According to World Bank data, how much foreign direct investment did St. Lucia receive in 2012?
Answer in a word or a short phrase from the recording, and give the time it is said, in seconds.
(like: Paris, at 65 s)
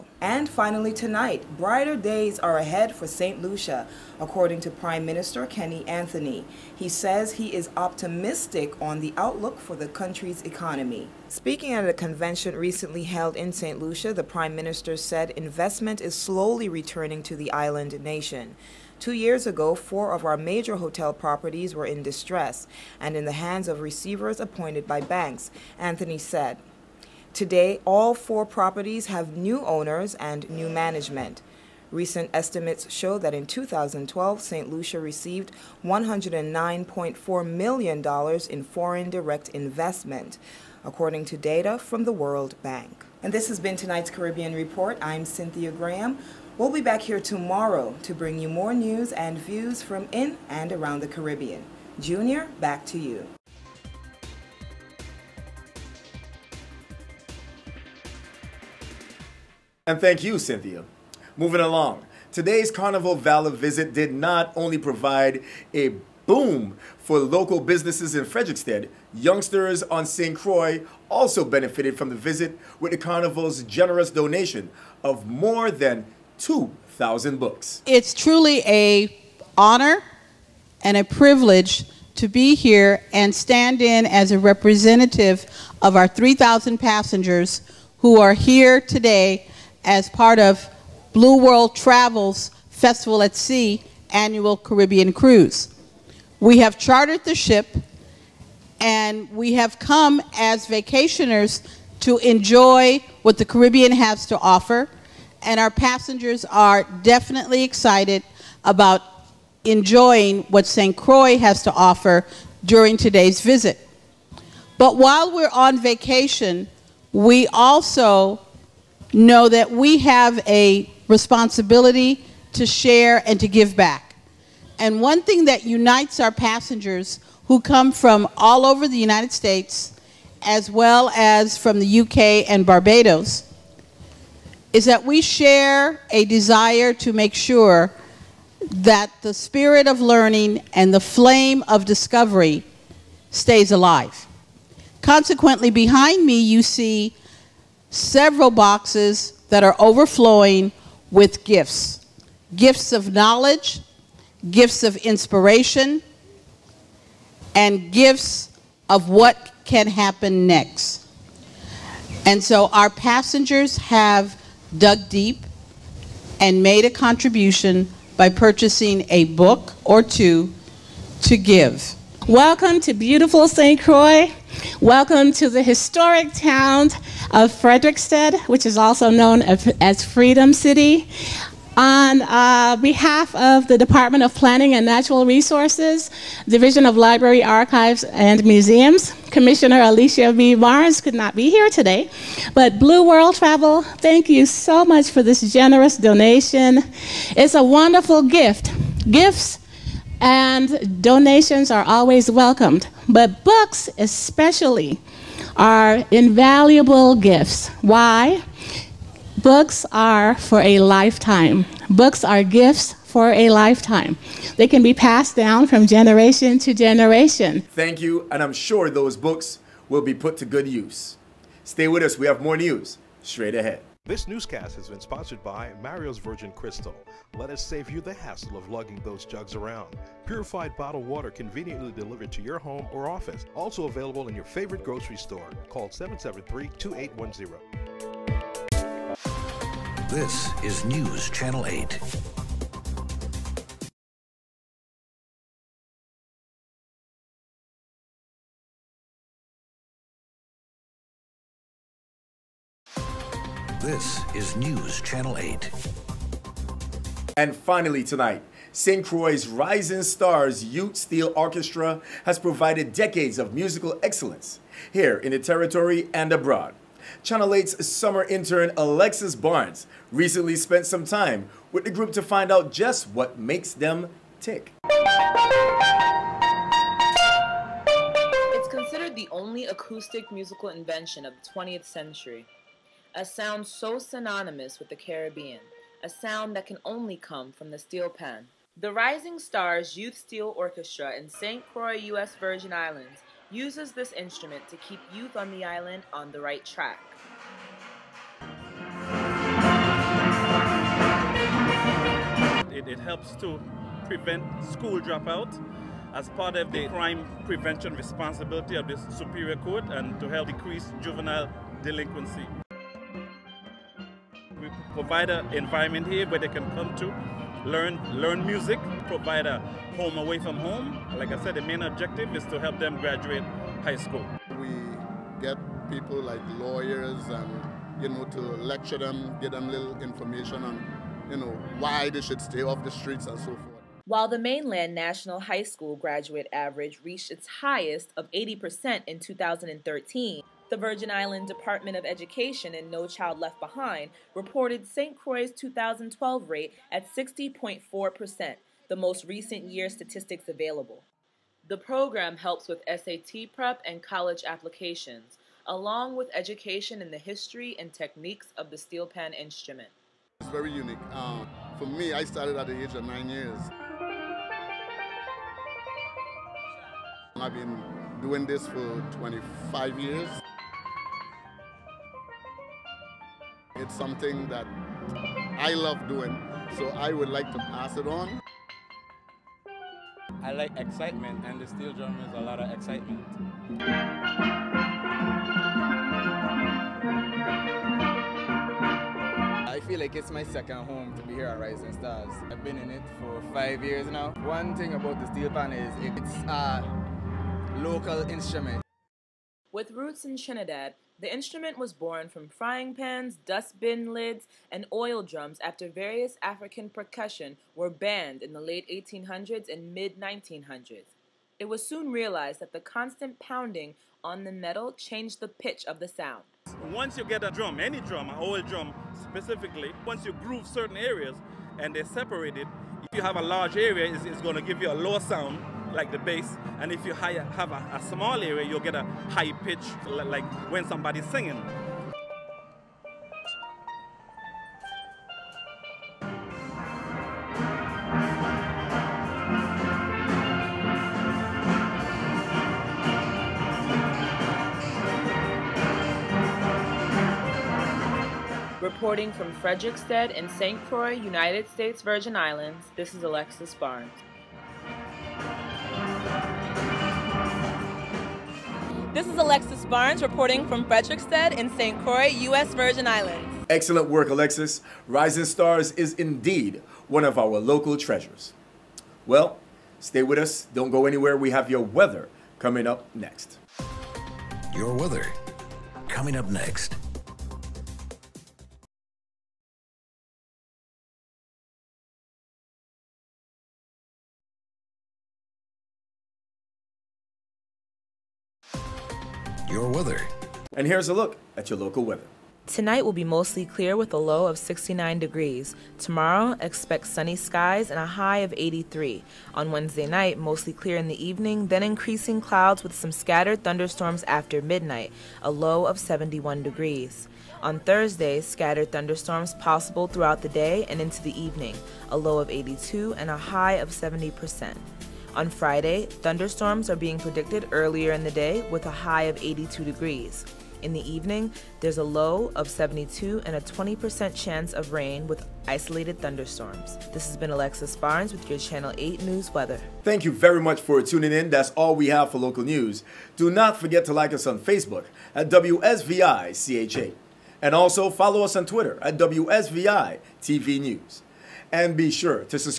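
$109.4 million, at 35 s.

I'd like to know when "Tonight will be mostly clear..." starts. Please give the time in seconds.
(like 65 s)
492 s.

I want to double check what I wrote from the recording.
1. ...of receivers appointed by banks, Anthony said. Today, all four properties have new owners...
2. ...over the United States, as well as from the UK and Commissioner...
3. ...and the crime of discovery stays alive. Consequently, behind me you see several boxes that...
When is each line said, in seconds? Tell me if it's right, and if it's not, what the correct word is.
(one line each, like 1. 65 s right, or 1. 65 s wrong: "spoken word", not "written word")
1. 23 s right
2. 128 s wrong: "Barbados", not "Commissioner"
3. 140 s wrong: "flame", not "crime".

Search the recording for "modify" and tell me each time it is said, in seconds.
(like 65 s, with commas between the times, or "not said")
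not said.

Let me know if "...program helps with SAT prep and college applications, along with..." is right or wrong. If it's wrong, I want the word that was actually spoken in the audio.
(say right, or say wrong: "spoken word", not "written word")
right.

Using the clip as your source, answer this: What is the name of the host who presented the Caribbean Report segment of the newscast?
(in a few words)
Cynthia Graham.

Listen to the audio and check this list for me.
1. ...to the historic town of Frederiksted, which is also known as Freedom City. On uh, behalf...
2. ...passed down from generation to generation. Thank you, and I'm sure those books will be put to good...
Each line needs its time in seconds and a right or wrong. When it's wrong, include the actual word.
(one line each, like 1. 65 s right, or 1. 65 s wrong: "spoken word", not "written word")
1. 175 s right
2. 214 s right.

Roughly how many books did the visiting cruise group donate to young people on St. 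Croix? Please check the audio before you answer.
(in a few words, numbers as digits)
more than 2,000.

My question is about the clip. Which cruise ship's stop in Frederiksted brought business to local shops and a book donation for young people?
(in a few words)
Carnival Valor.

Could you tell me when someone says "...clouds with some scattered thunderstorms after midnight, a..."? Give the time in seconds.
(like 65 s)
502 s.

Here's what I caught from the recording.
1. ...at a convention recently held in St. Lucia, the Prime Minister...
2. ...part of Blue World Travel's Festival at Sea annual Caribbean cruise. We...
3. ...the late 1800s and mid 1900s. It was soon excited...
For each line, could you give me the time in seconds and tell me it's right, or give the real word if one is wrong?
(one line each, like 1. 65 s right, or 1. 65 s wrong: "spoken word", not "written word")
1. 11 s right
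2. 90 s right
3. 408 s wrong: "realized", not "excited".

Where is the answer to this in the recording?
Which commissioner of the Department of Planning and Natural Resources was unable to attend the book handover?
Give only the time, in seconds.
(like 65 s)
189 s.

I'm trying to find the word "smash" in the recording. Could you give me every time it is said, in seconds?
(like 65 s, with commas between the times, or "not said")
not said.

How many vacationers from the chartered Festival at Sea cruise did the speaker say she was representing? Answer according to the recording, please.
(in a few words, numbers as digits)
3,000.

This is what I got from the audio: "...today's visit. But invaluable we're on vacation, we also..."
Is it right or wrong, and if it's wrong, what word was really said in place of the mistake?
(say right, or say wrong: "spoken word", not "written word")
wrong: "while", not "invaluable".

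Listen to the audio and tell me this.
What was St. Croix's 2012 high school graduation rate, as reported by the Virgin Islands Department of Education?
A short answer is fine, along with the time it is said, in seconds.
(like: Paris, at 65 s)
60.4%, at 347 s.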